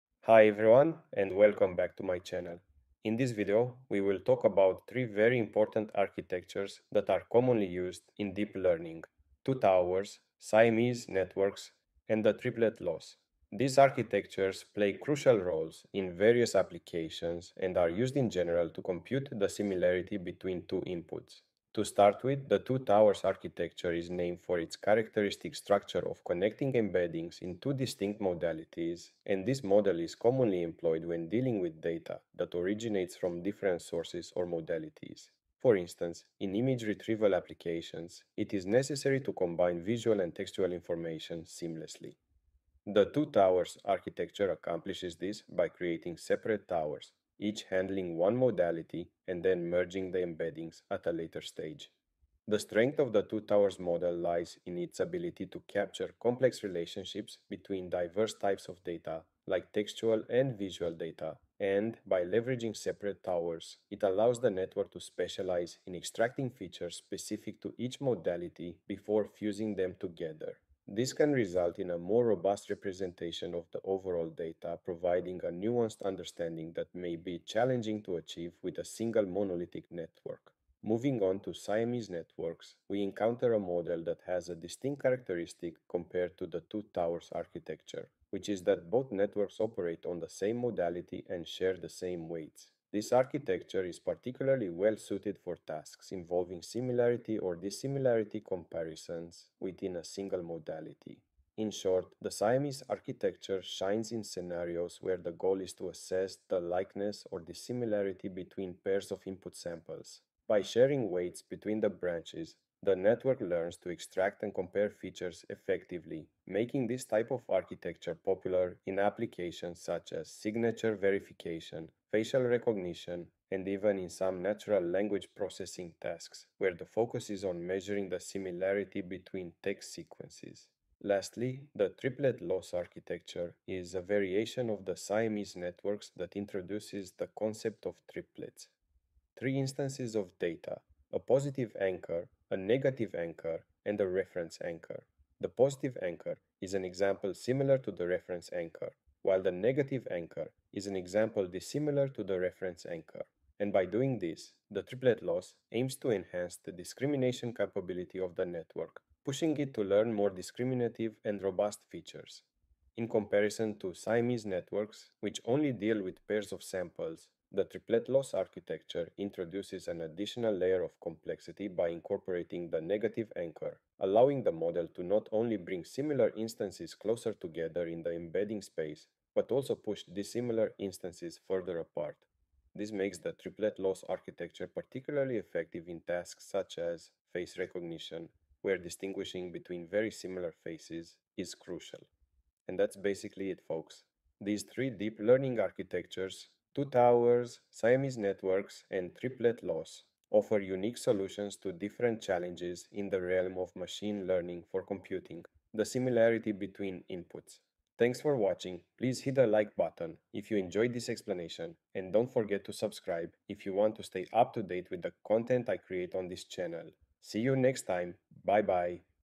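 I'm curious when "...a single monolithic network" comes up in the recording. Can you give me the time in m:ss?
1:18.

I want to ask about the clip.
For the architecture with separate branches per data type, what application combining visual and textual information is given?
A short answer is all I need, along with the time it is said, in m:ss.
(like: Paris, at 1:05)
Image retrieval, at 0:36.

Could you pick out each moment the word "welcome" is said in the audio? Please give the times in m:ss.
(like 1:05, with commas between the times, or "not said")
0:01.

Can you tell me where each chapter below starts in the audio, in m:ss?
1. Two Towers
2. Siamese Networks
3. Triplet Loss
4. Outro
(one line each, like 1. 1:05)
1. 0:21
2. 1:21
3. 2:12
4. 3:12.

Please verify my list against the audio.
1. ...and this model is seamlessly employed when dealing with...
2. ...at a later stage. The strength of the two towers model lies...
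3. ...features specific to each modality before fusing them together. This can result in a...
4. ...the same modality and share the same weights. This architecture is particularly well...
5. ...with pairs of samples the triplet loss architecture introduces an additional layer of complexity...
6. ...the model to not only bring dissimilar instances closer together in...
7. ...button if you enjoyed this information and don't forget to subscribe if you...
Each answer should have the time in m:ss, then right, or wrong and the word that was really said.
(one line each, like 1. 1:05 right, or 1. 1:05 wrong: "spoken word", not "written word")
1. 0:29 wrong: "commonly", not "seamlessly"
2. 0:50 right
3. 1:06 right
4. 1:30 right
5. 2:46 right
6. 2:54 wrong: "similar", not "dissimilar"
7. 3:29 wrong: "explanation", not "information".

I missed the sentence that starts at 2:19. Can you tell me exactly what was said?
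Three instances of data a positive anchor, a negative anchor, and a reference anchor.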